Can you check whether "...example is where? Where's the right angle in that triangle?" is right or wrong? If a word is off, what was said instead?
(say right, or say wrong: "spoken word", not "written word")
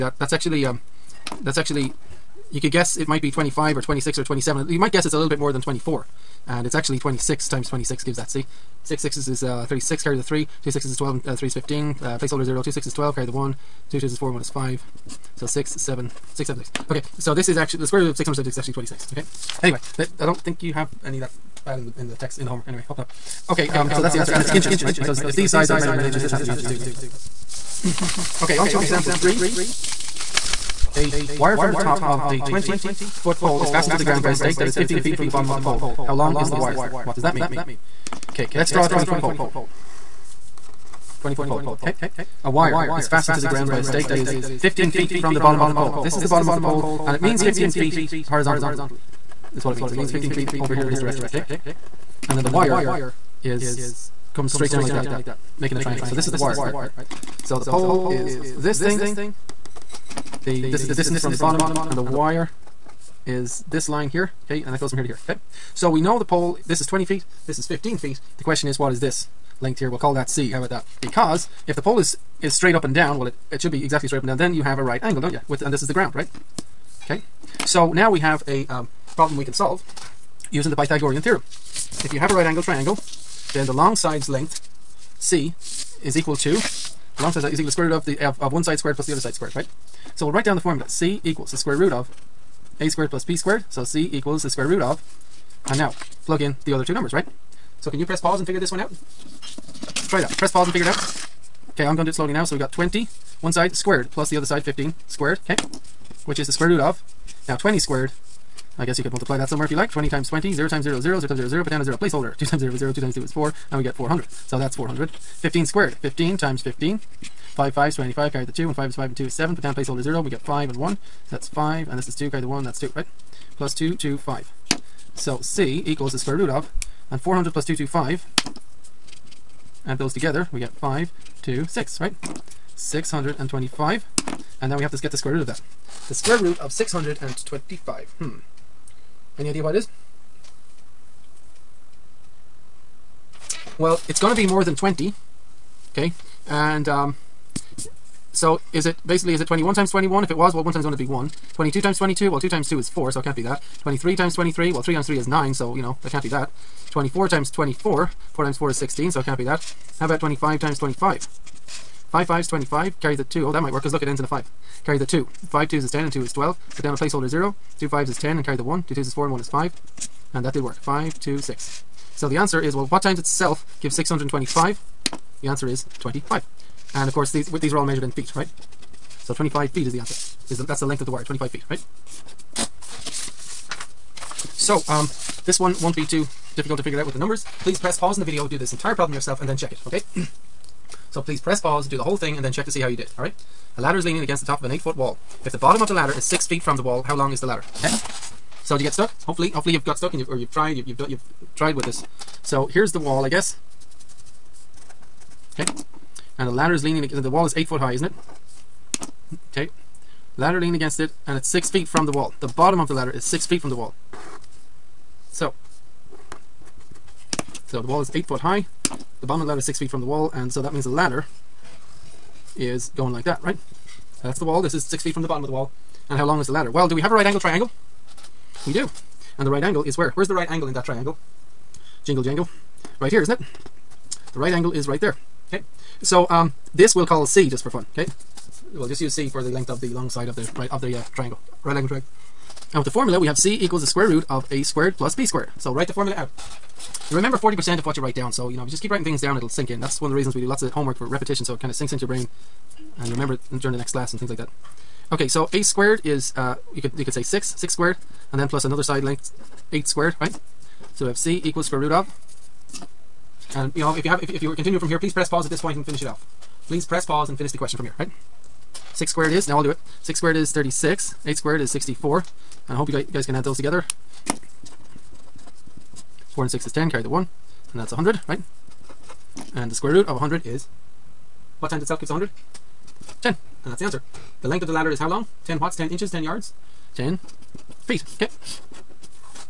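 wrong: "angle", not "example".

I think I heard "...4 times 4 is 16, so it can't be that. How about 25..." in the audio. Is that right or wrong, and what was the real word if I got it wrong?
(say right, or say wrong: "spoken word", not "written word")
right.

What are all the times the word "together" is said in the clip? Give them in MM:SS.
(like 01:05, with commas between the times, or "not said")
02:10, 04:33.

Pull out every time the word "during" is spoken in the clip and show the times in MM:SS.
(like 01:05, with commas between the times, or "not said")
04:13.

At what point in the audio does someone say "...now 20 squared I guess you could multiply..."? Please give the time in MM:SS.
01:47.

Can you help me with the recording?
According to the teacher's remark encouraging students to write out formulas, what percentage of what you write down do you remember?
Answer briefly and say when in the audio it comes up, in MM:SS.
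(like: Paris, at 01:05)
40%, at 04:07.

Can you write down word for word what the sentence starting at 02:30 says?
If it was, well, 1 times 1 would be 1.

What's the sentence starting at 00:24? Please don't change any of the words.
Because if these sides are measured in inches, this has to be inches too, right?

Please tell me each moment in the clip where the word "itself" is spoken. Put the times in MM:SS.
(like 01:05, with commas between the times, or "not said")
02:53, 04:41.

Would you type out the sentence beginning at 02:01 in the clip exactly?
So that's 5, and this is 2, carry the 1, that's 2, right?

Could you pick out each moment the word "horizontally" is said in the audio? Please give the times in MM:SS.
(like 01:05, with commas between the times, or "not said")
00:48.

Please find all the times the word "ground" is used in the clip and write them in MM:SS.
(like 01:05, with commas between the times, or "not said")
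00:34, 00:43, 01:15.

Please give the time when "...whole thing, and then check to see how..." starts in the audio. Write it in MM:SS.
03:12.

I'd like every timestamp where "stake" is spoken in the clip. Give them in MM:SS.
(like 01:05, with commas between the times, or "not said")
00:34, 00:43.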